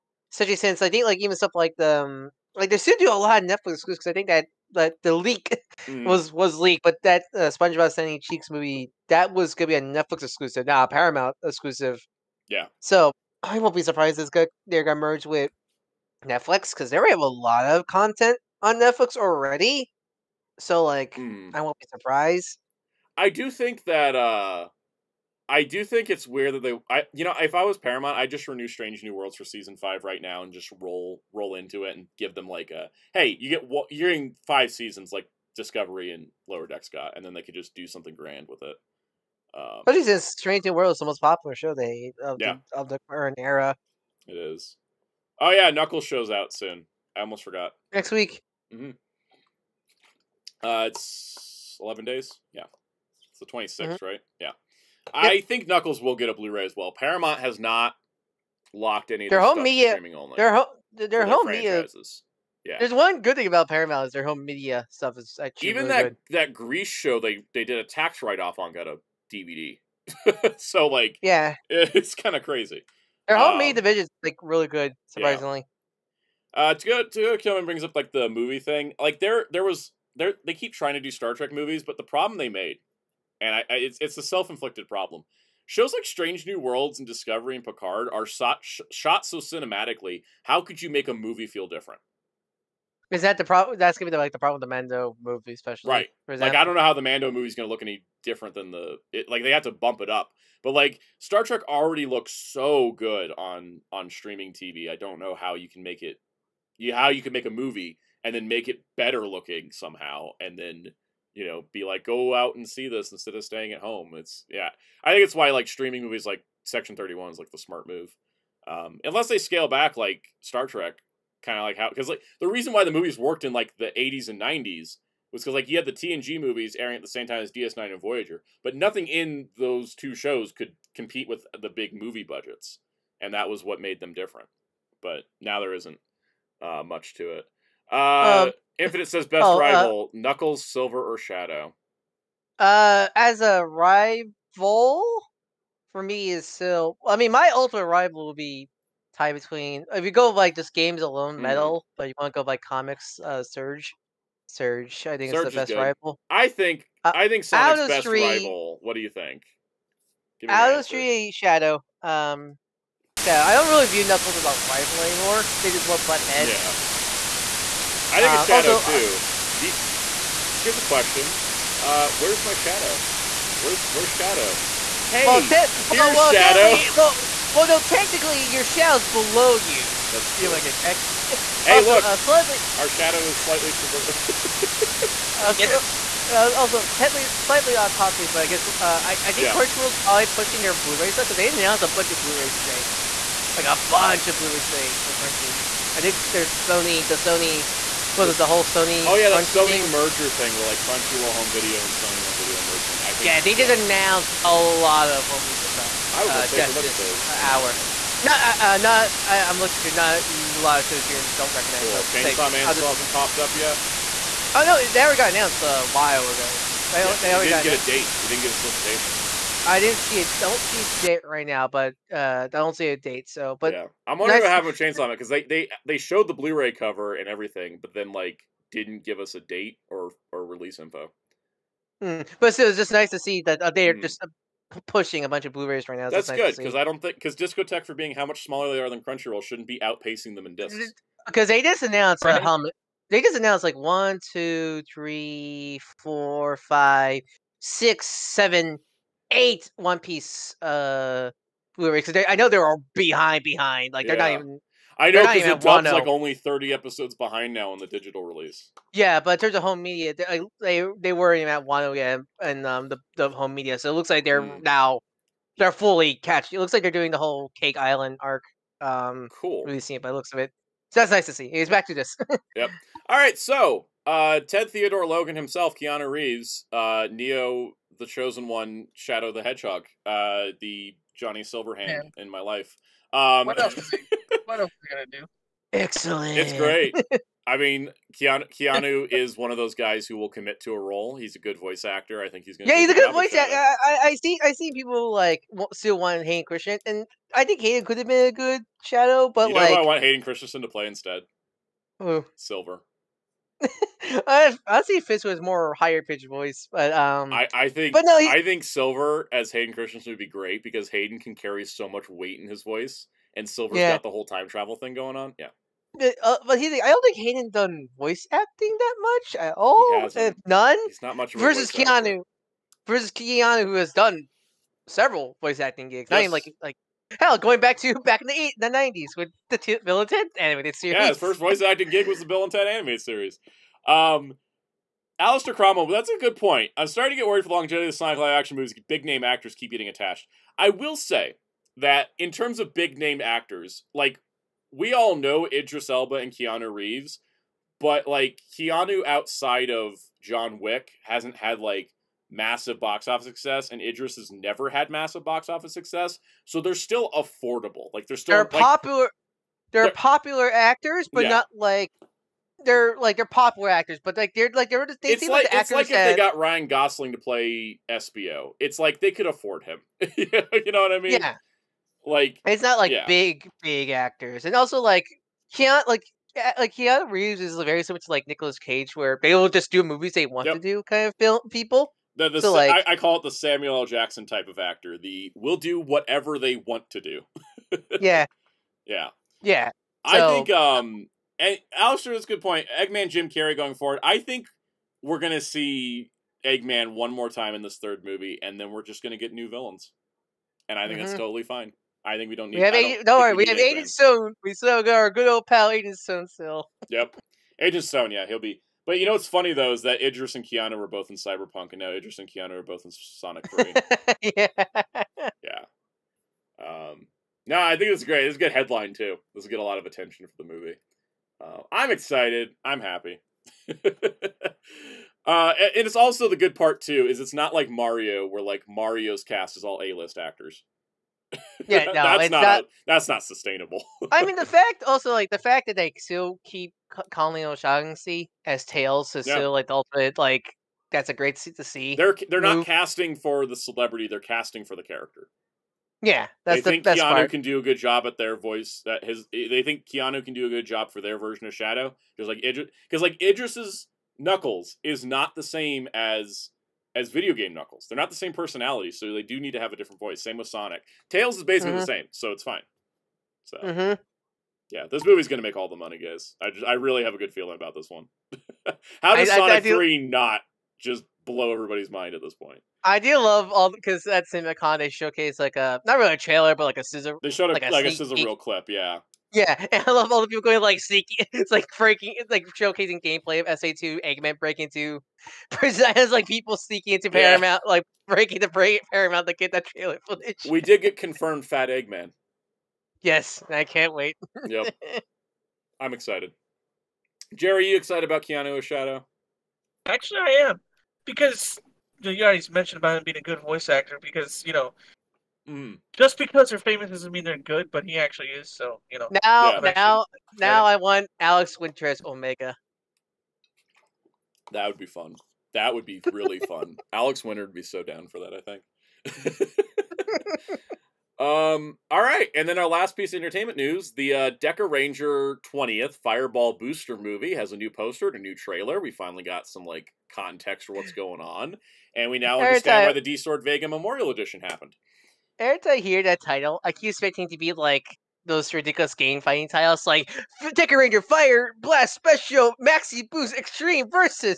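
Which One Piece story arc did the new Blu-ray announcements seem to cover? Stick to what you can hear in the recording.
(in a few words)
Cake Island arc.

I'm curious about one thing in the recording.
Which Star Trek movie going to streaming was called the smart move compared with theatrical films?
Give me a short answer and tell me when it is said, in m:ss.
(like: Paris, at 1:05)
Section Thirty One, at 1:56.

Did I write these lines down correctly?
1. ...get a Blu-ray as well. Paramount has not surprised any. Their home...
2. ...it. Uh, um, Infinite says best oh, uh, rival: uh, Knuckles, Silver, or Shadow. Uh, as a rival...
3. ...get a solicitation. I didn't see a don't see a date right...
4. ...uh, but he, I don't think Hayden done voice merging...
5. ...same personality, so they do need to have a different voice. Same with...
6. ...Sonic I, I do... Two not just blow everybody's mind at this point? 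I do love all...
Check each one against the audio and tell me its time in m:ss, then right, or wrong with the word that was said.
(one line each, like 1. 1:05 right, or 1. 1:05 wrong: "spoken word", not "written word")
1. 0:56 wrong: "locked", not "surprised"
2. 2:17 right
3. 3:38 right
4. 5:16 wrong: "acting", not "merging"
5. 7:38 right
6. 7:49 wrong: "Three", not "Two".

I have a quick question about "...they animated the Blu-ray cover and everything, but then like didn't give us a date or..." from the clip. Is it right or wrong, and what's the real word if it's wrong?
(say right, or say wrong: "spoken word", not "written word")
wrong: "showed", not "animated".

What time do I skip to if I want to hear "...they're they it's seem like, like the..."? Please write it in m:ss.
6:04.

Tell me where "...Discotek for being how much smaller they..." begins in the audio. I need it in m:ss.
3:57.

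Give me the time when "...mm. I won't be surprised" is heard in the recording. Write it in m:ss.
0:21.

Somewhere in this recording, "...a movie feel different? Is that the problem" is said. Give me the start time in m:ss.
1:31.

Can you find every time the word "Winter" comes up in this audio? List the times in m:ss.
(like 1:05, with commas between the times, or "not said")
8:31, 8:37.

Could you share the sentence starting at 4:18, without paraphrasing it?
Yeah, but in terms of home media, they they, they were even at one oh yeah, and um the, the home media.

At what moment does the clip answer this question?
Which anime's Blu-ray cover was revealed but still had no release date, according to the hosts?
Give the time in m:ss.
3:32.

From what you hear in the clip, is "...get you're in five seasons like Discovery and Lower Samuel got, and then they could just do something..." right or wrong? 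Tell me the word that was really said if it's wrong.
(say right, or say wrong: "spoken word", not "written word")
wrong: "Decks", not "Samuel".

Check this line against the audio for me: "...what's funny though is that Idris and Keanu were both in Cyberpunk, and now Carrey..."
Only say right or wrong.
wrong.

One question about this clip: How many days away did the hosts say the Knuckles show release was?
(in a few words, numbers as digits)
11.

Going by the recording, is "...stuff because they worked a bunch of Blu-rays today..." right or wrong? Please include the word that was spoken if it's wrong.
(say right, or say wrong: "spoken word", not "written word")
wrong: "announced", not "worked".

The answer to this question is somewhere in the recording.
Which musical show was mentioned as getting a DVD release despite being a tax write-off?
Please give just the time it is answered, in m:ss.
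1:06.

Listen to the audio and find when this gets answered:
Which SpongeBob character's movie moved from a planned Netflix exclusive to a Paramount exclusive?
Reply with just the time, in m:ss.
0:07.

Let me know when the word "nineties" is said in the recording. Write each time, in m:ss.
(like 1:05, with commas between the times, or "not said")
2:04, 5:28.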